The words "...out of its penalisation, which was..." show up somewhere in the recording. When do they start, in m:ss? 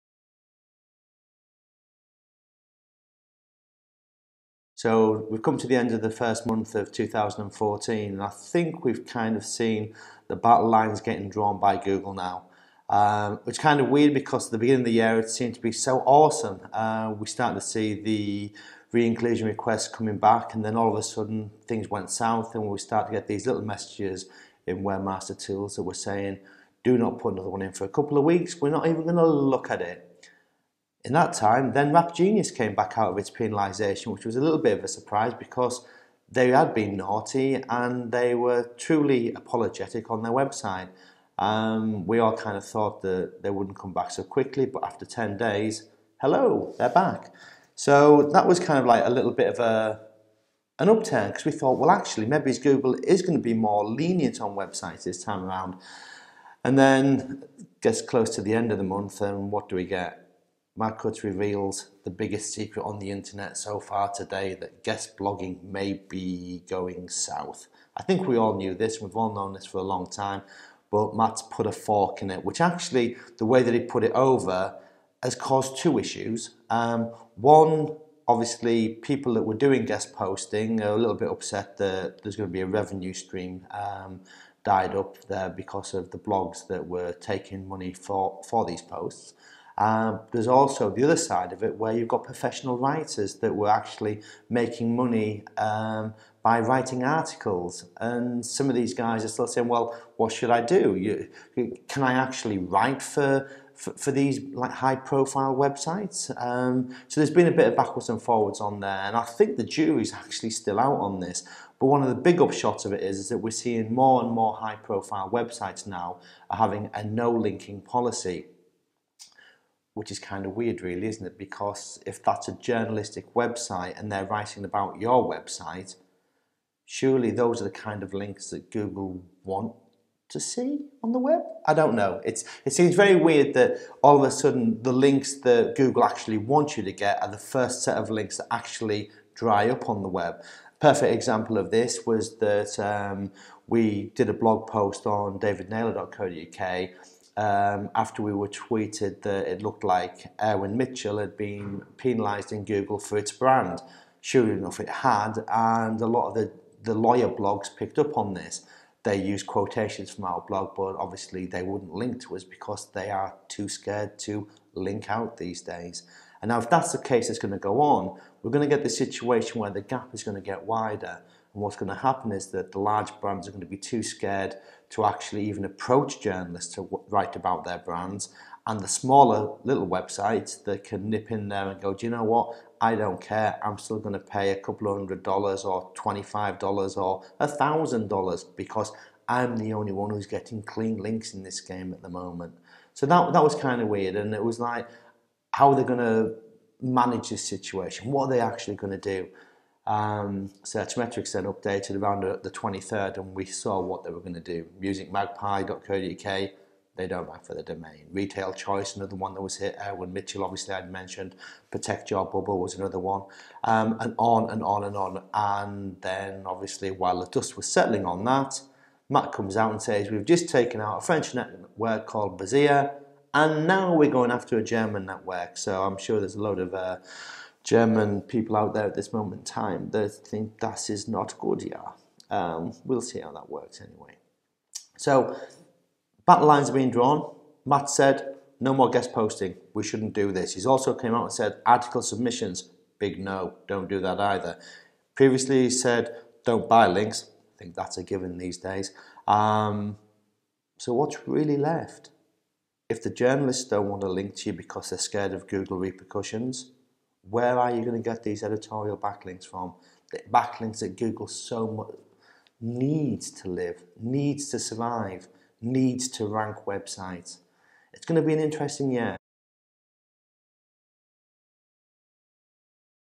0:32.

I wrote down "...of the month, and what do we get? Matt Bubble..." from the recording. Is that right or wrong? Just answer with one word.
wrong.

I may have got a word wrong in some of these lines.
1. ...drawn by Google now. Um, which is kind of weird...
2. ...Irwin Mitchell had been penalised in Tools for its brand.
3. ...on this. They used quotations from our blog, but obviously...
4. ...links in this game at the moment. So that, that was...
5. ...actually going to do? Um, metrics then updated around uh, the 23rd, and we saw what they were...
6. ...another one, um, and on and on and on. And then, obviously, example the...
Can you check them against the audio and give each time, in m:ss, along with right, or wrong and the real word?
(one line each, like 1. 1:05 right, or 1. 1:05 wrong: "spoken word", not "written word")
1. 0:11 right
2. 2:30 wrong: "Google", not "Tools"
3. 2:38 right
4. 3:10 right
5. 3:18 right
6. 3:32 wrong: "while", not "example".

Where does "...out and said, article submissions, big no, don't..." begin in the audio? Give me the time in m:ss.
4:01.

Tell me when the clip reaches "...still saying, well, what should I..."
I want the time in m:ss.
1:39.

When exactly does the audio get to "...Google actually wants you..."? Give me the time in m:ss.
2:15.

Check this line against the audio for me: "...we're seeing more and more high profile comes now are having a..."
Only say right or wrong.
wrong.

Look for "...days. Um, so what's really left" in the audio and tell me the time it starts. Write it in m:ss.
4:08.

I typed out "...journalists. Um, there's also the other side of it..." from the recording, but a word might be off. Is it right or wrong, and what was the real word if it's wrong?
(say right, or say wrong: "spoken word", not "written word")
wrong: "posts", not "journalists".